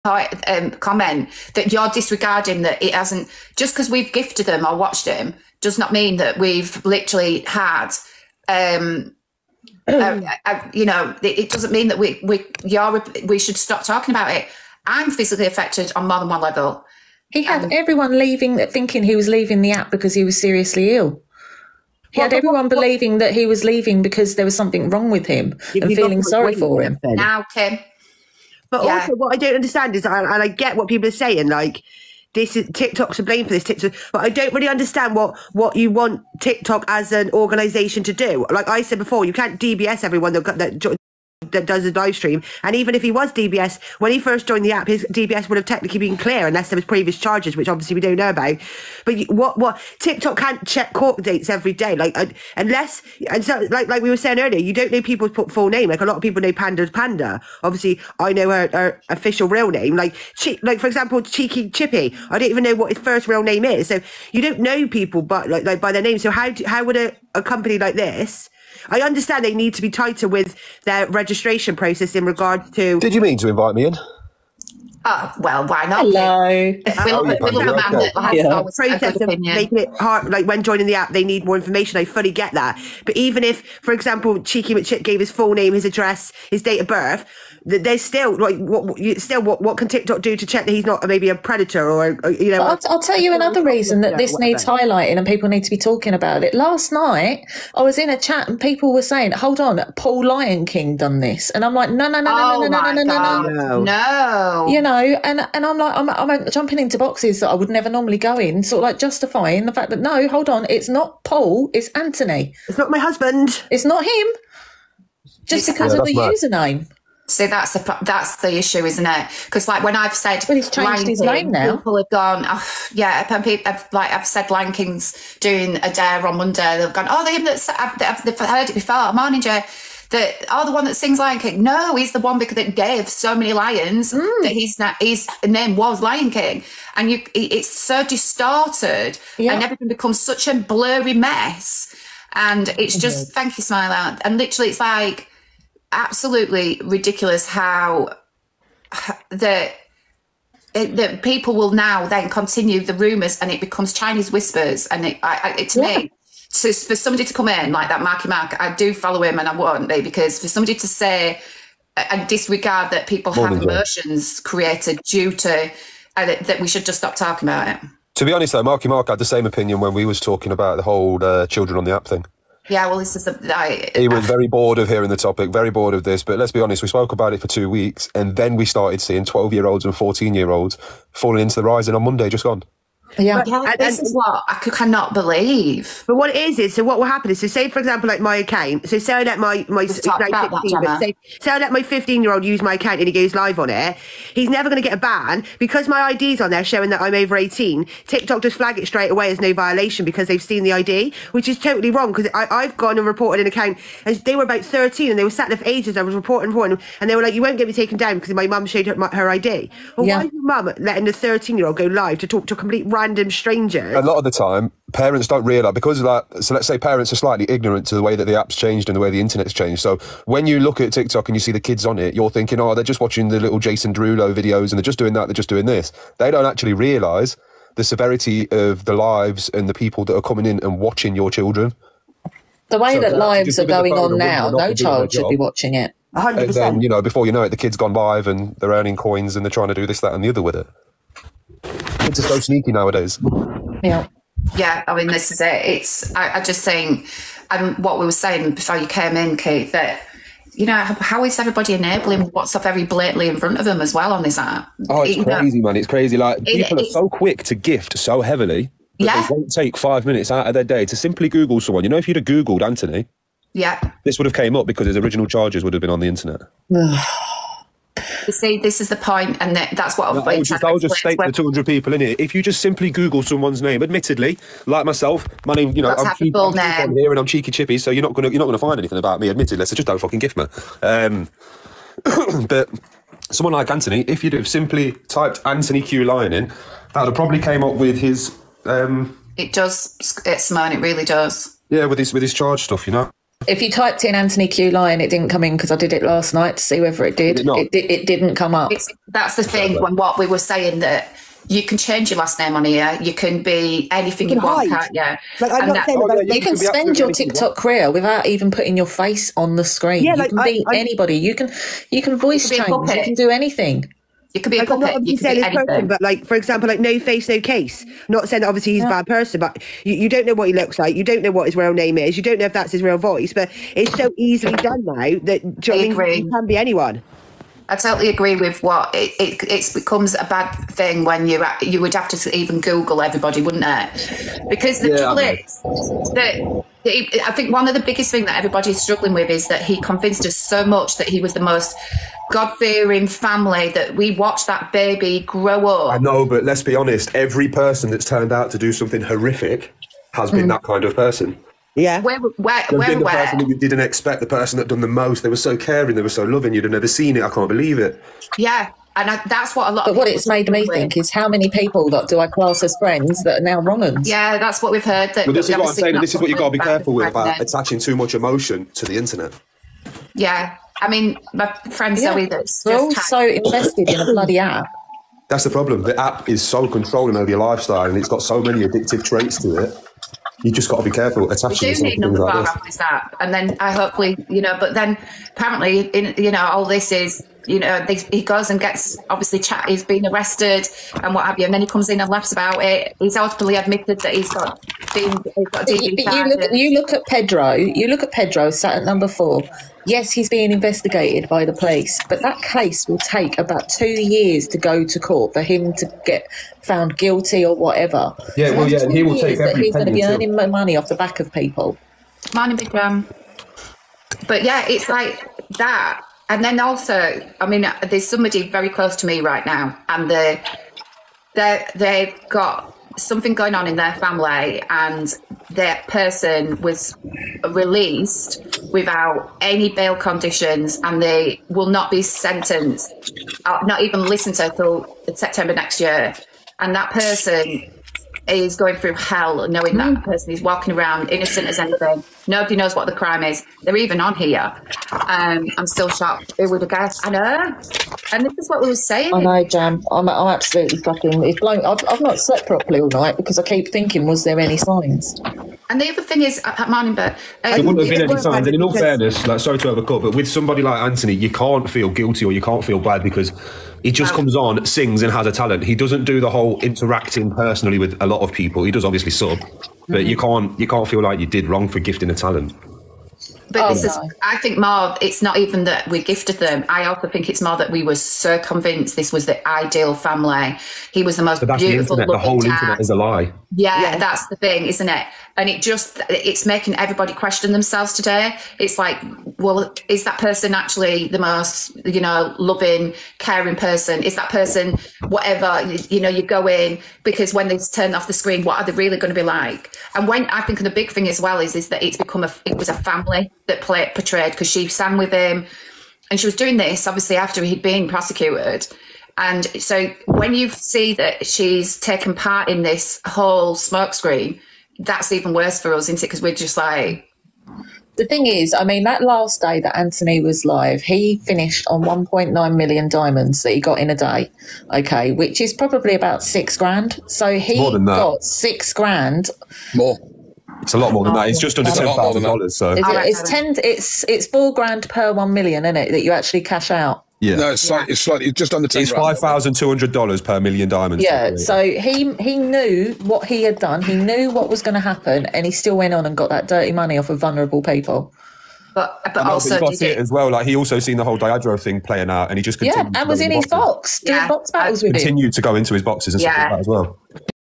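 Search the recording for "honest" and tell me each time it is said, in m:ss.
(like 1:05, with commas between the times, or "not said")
2:48, 2:56, 5:46.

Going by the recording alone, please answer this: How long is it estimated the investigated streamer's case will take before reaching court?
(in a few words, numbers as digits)
2 years.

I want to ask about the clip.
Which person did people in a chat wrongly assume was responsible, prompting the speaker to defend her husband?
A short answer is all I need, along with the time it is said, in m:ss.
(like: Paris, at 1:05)
Paul Lion King, at 1:39.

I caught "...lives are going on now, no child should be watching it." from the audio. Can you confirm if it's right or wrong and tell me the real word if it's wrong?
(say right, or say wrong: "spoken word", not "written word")
right.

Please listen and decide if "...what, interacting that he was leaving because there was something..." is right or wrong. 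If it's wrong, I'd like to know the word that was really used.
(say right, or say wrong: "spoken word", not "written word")
wrong: "believing", not "interacting".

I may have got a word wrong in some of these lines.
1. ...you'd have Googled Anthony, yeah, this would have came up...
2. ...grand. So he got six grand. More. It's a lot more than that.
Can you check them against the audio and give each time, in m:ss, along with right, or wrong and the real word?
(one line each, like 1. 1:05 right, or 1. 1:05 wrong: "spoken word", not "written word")
1. 4:22 right
2. 8:46 right.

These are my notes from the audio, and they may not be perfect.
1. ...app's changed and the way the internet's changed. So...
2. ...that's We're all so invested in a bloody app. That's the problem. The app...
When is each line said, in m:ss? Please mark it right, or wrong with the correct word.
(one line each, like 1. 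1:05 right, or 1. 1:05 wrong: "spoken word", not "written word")
1. 3:38 right
2. 6:12 right.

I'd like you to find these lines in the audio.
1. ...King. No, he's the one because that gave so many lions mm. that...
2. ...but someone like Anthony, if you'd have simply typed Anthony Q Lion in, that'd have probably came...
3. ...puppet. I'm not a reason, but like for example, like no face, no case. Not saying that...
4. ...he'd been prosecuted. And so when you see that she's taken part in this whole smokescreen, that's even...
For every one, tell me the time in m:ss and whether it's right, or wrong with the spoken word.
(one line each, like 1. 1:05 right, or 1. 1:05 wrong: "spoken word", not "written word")
1. 2:11 right
2. 4:42 right
3. 5:14 wrong: "person", not "reason"
4. 8:27 right.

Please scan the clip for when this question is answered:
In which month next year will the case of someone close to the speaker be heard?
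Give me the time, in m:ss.
7:15.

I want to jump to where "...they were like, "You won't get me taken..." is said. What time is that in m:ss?
3:27.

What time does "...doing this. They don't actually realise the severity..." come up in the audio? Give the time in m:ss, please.
3:45.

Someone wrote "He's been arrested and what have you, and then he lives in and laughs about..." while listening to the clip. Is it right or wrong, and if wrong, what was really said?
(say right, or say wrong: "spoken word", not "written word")
wrong: "comes", not "lives".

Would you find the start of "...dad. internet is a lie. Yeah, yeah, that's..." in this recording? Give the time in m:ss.
8:02.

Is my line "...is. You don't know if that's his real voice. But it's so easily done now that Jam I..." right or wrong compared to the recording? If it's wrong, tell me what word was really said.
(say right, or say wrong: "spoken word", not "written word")
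wrong: "Johnny", not "Jam".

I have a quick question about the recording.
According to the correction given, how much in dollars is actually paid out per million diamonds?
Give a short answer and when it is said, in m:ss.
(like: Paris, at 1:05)
$5,200, at 8:58.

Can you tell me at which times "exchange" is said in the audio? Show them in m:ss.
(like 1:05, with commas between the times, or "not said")
not said.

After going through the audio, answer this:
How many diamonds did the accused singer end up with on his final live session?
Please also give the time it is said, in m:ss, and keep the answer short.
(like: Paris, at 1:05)
1.9 million, at 8:41.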